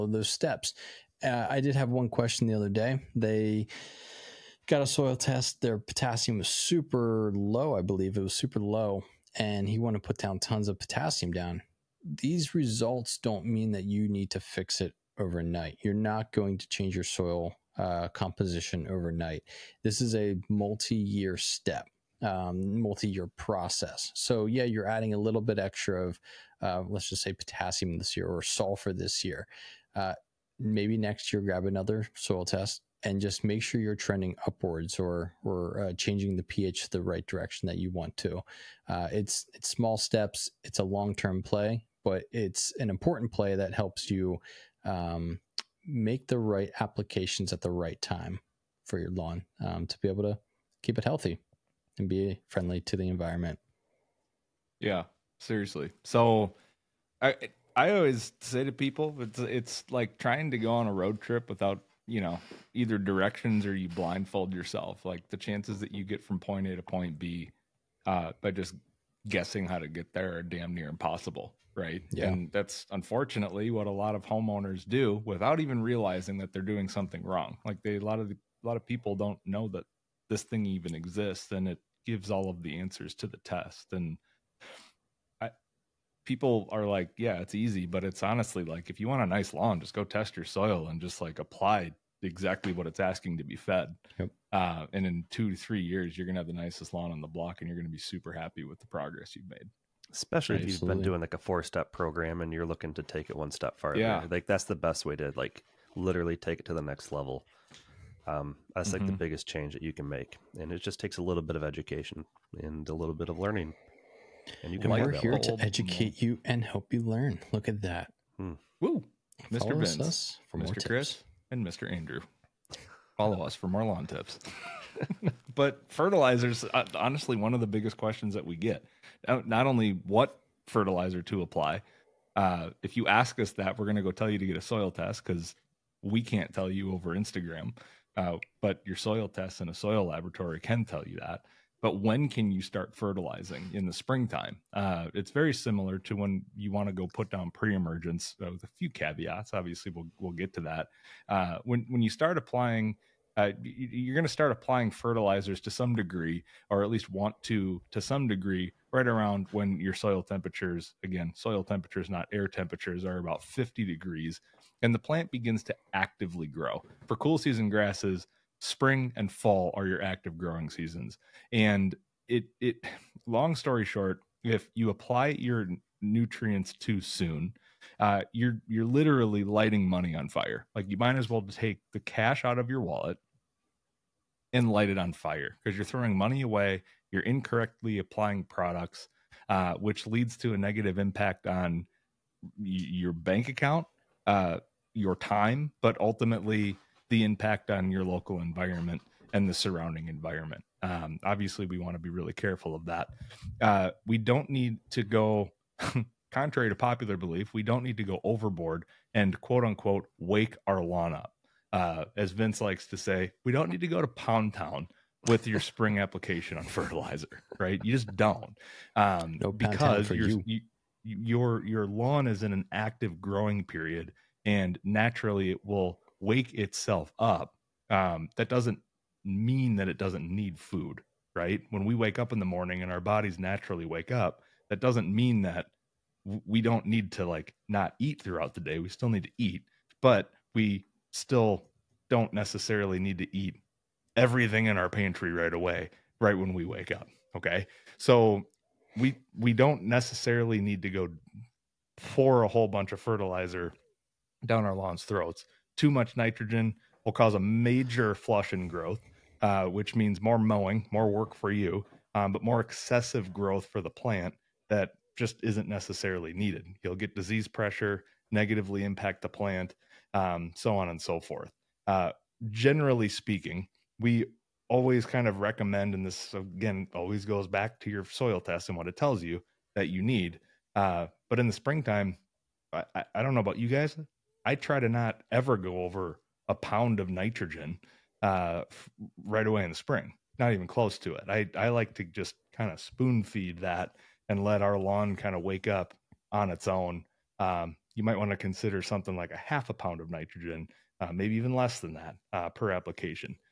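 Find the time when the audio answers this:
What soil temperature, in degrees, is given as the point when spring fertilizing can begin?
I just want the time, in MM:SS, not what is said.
02:43.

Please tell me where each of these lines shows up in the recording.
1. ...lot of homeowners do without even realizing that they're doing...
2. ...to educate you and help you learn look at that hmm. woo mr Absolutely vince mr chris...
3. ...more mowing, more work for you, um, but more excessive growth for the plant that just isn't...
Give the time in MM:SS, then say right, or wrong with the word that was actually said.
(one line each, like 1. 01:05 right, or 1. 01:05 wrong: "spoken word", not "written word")
1. 01:13 right
2. 01:55 wrong: "Follow", not "Absolutely"
3. 04:20 right.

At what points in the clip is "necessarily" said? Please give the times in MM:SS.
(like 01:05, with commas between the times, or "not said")
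04:02, 04:09, 04:25.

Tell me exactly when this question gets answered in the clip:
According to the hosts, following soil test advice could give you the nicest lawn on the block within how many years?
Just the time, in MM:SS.
01:35.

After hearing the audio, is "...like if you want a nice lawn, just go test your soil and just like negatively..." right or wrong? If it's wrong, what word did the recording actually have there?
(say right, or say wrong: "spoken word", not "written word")
wrong: "apply", not "negatively".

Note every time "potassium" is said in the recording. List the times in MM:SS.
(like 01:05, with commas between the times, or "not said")
00:05, 00:10, 00:27.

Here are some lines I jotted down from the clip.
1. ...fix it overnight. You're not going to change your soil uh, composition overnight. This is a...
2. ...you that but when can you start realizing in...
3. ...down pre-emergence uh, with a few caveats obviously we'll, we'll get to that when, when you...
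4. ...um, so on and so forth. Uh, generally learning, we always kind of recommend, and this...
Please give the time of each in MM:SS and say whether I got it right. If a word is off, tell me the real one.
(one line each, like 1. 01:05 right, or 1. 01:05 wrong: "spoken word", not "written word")
1. 00:14 right
2. 02:21 wrong: "fertilizing", not "realizing"
3. 02:27 right
4. 04:30 wrong: "speaking", not "learning".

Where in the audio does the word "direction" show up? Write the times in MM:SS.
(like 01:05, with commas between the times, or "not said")
00:37, 01:02.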